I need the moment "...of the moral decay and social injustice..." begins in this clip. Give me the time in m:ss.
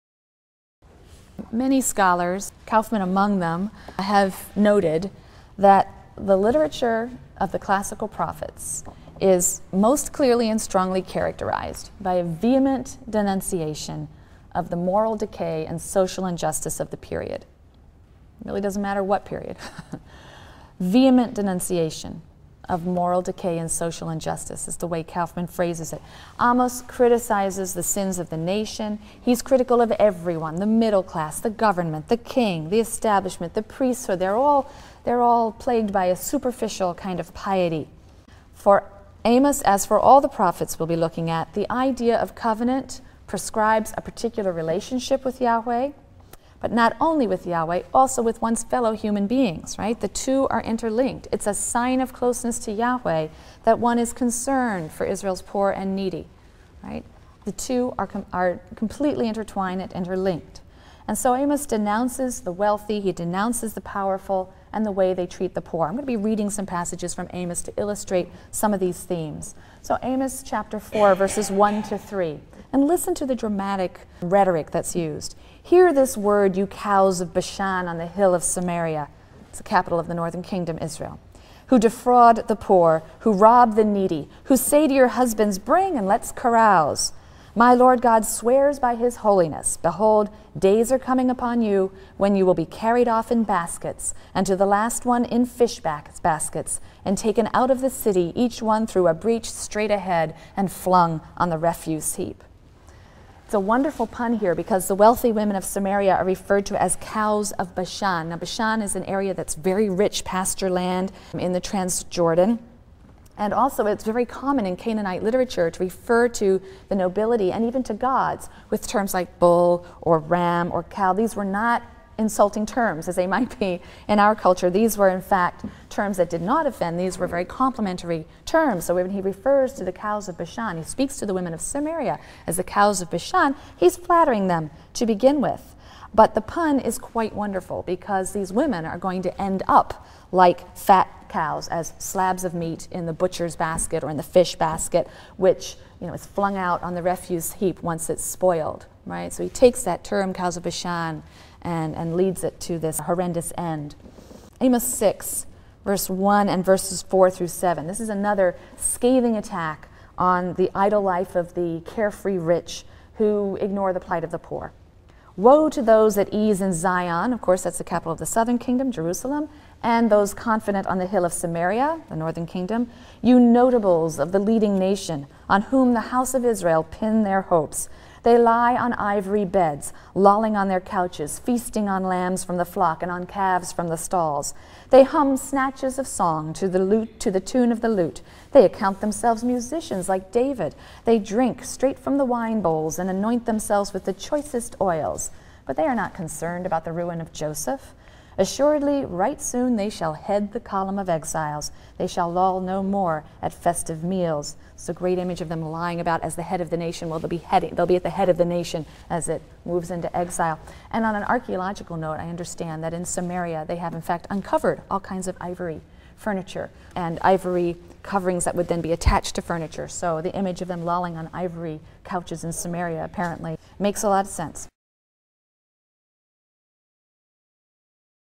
0:14.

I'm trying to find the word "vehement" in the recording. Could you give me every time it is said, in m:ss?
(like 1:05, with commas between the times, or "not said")
0:12, 0:20.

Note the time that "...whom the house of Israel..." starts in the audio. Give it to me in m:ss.
2:55.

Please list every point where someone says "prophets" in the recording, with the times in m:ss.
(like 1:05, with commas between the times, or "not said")
0:08, 0:40.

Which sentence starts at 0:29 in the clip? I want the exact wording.
He's critical of everyone the middle class, the government, the king, the establishment, the priesthood.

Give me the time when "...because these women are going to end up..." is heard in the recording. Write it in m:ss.
2:17.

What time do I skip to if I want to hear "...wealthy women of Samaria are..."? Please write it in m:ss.
1:44.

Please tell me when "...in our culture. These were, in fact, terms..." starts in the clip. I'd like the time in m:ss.
2:04.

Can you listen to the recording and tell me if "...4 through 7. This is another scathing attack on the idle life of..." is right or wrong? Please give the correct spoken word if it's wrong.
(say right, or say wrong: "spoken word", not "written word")
right.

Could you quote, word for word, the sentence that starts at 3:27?
Well, they'll be heading, they'll be at the head of the nation as it moves into exile.